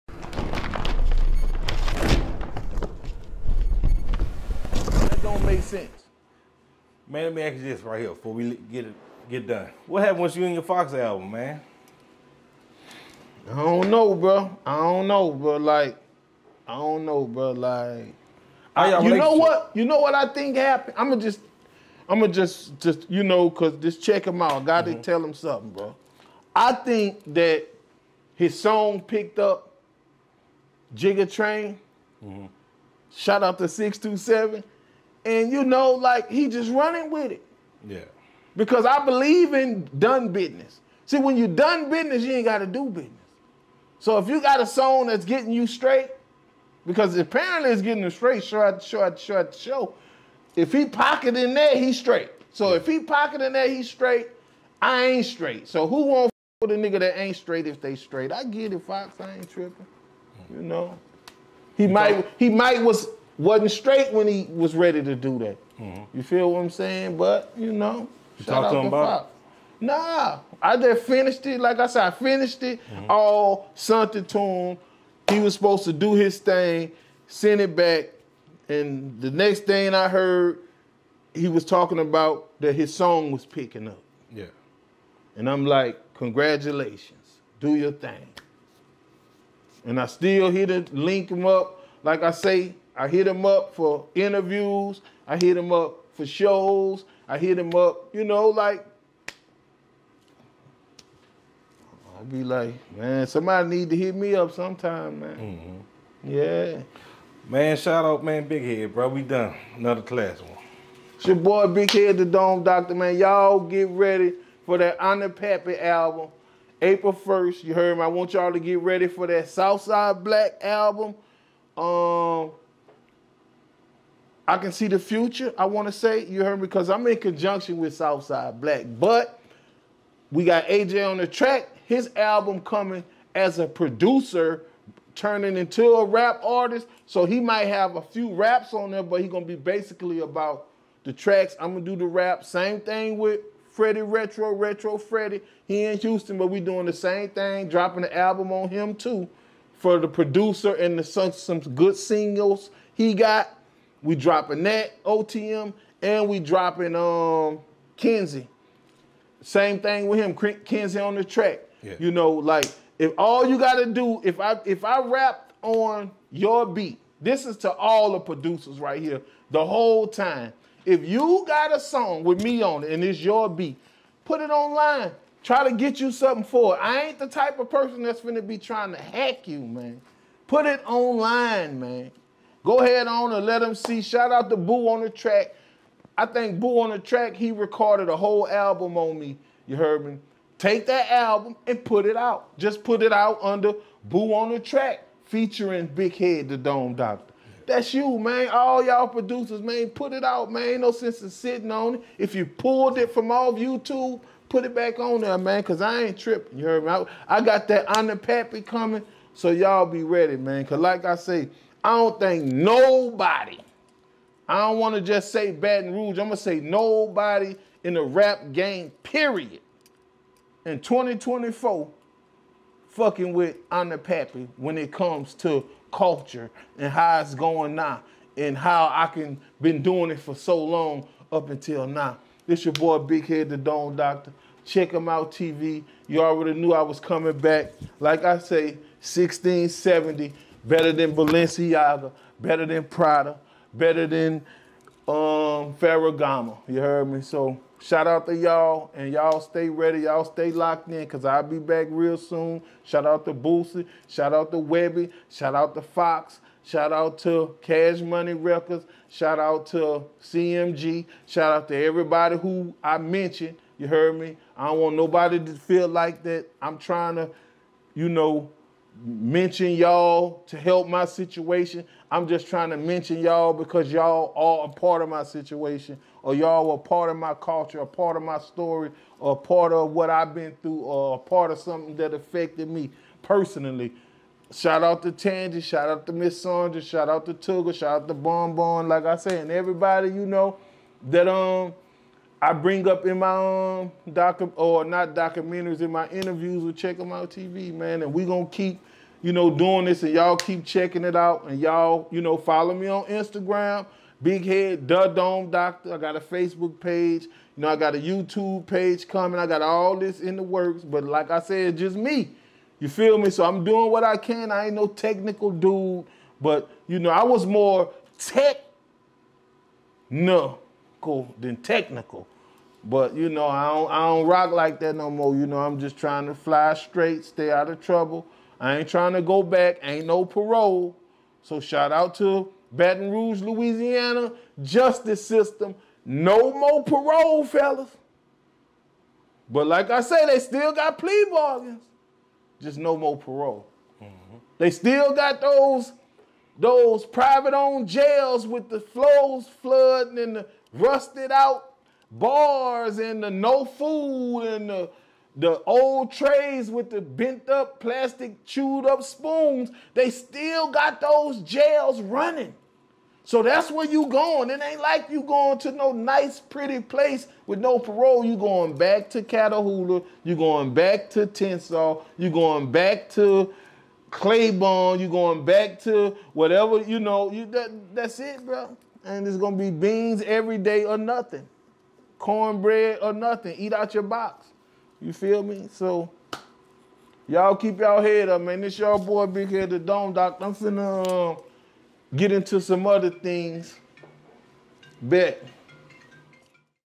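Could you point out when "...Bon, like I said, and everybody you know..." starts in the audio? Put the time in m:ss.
4:48.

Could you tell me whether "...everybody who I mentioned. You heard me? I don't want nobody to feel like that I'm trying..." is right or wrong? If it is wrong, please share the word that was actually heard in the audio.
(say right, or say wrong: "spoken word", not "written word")
right.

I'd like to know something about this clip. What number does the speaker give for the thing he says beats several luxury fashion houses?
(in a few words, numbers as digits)
1670.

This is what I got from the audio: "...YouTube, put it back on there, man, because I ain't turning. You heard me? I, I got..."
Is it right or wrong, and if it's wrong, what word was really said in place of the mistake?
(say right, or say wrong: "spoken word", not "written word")
wrong: "tripping", not "turning".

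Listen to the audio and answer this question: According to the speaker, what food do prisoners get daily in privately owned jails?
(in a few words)
Beans.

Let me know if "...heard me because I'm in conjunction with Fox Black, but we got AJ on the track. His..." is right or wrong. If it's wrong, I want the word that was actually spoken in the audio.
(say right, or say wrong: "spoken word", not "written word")
wrong: "Southside", not "Fox".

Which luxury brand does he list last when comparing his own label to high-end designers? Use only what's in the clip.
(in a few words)
Ferragamo.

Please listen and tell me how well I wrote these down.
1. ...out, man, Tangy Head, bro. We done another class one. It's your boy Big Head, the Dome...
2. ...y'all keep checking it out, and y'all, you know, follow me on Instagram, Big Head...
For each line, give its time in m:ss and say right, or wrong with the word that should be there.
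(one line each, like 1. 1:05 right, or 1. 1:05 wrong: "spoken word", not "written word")
1. 1:48 wrong: "Big", not "Tangy"
2. 5:00 right.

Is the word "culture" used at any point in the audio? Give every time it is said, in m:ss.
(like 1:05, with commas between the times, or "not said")
3:45, 4:37.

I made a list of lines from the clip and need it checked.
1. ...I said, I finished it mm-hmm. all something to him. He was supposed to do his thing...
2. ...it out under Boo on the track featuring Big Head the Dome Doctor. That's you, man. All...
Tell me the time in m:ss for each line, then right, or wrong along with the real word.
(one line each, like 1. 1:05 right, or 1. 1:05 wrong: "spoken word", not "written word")
1. 1:11 right
2. 3:13 right.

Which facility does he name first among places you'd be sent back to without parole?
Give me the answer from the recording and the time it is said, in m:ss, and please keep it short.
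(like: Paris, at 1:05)
Catahoula, at 6:09.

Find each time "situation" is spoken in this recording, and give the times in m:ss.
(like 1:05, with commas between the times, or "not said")
4:31, 4:35.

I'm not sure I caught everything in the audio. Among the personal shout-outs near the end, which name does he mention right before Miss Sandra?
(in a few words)
Tangy.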